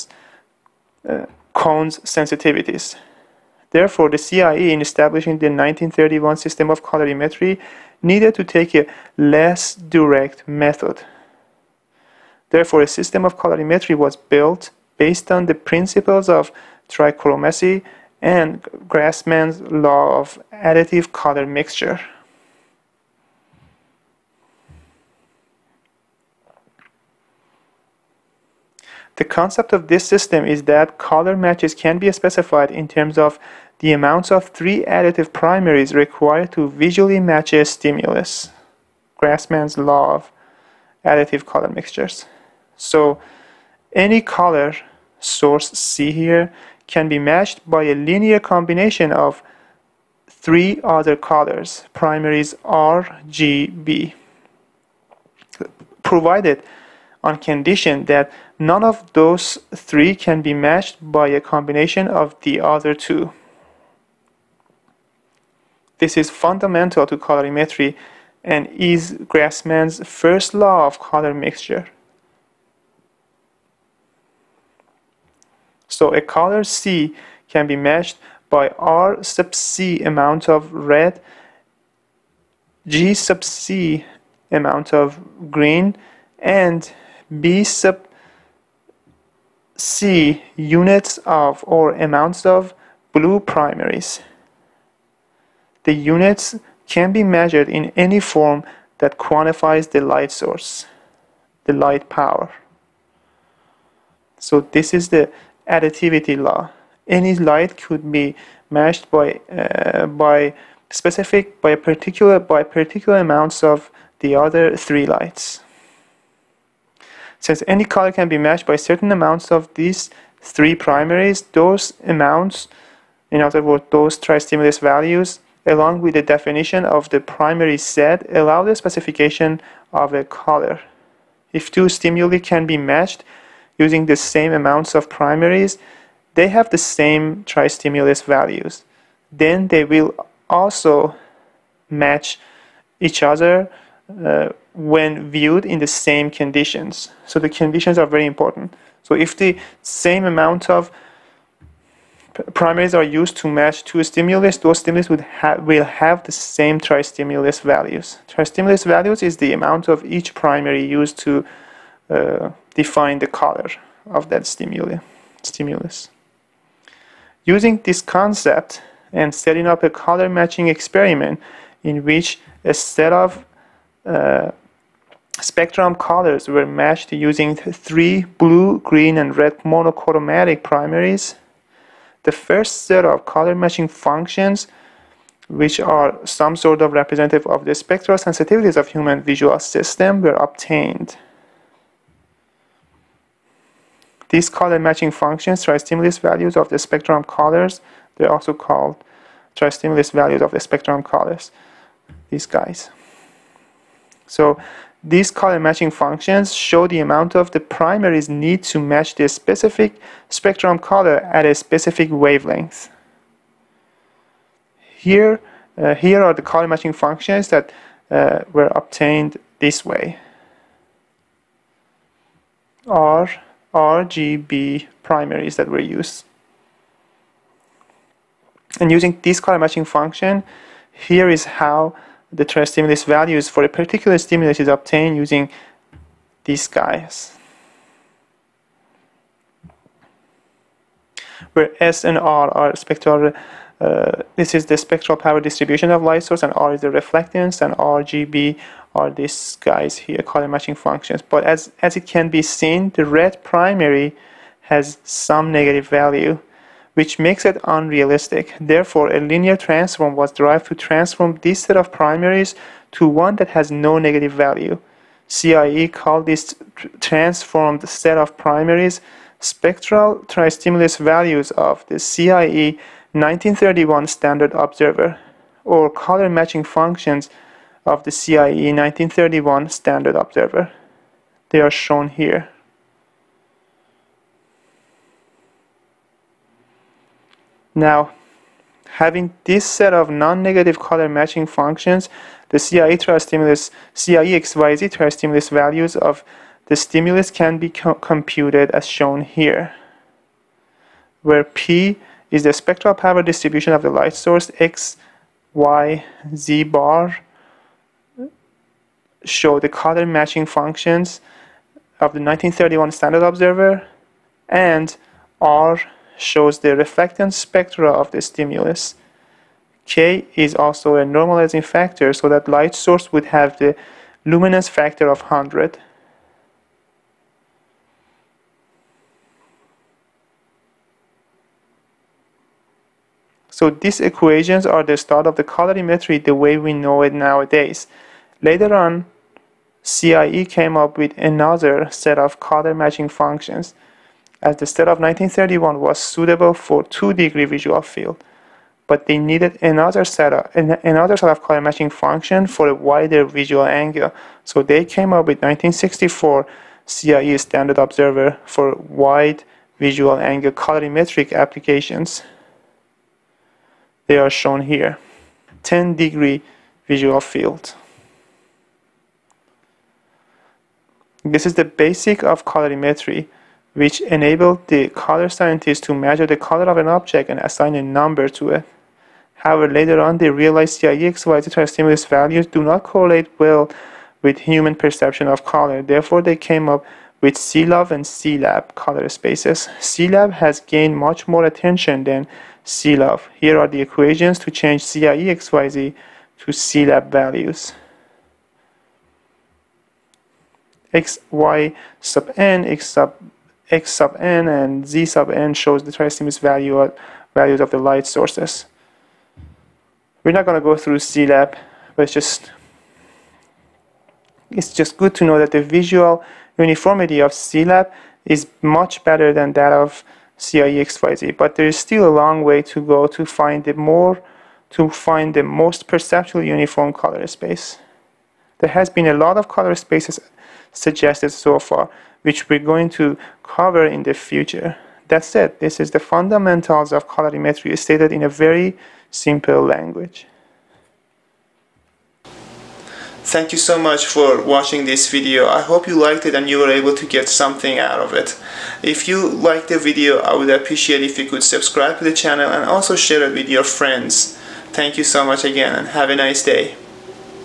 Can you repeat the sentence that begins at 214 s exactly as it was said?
Here, uh, here are the color matching functions that uh, were obtained this way.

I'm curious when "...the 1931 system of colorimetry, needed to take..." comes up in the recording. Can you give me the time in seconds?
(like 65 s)
5 s.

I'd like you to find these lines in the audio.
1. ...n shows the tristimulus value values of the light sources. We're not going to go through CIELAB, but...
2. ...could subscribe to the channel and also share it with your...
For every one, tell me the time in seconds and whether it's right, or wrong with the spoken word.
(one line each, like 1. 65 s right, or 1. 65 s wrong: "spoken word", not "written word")
1. 405 s right
2. 451 s right.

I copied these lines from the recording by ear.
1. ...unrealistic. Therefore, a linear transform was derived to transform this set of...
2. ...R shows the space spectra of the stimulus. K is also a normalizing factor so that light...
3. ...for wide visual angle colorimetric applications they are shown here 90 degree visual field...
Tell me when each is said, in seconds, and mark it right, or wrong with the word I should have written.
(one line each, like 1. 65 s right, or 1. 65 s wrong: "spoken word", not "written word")
1. 257 s right
2. 315 s wrong: "reflectance", not "space"
3. 358 s wrong: "10", not "90".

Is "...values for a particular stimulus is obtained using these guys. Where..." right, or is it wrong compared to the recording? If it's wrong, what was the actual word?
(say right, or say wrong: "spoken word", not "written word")
right.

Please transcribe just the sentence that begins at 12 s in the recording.
Therefore, a system of colorimetry was built based on the principles of trichromacy and Grassmann's law of additive color mixture.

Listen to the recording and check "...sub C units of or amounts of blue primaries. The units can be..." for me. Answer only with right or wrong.
right.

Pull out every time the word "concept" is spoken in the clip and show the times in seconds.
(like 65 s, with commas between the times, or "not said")
29 s, 168 s.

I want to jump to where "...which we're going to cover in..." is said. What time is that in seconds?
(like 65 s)
432 s.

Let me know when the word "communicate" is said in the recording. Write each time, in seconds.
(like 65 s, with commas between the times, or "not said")
not said.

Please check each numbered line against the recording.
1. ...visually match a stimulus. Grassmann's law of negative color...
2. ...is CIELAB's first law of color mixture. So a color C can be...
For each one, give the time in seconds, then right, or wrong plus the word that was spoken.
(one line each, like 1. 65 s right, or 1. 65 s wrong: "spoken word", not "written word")
1. 36 s wrong: "additive", not "negative"
2. 68 s wrong: "Grassmann", not "CIELAB".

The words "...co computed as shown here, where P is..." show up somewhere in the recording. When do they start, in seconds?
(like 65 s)
297 s.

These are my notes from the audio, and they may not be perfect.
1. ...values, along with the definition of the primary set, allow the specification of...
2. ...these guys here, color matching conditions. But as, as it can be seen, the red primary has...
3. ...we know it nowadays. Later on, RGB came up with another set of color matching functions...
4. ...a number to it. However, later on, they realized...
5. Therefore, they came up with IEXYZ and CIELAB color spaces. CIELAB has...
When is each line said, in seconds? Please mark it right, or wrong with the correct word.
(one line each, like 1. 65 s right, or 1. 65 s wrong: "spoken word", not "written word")
1. 124 s right
2. 249 s wrong: "functions", not "conditions"
3. 336 s wrong: "CIE", not "RGB"
4. 377 s right
5. 385 s wrong: "CIELUV", not "IEXYZ".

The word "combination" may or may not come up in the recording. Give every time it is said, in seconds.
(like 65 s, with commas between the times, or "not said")
48 s, 61 s.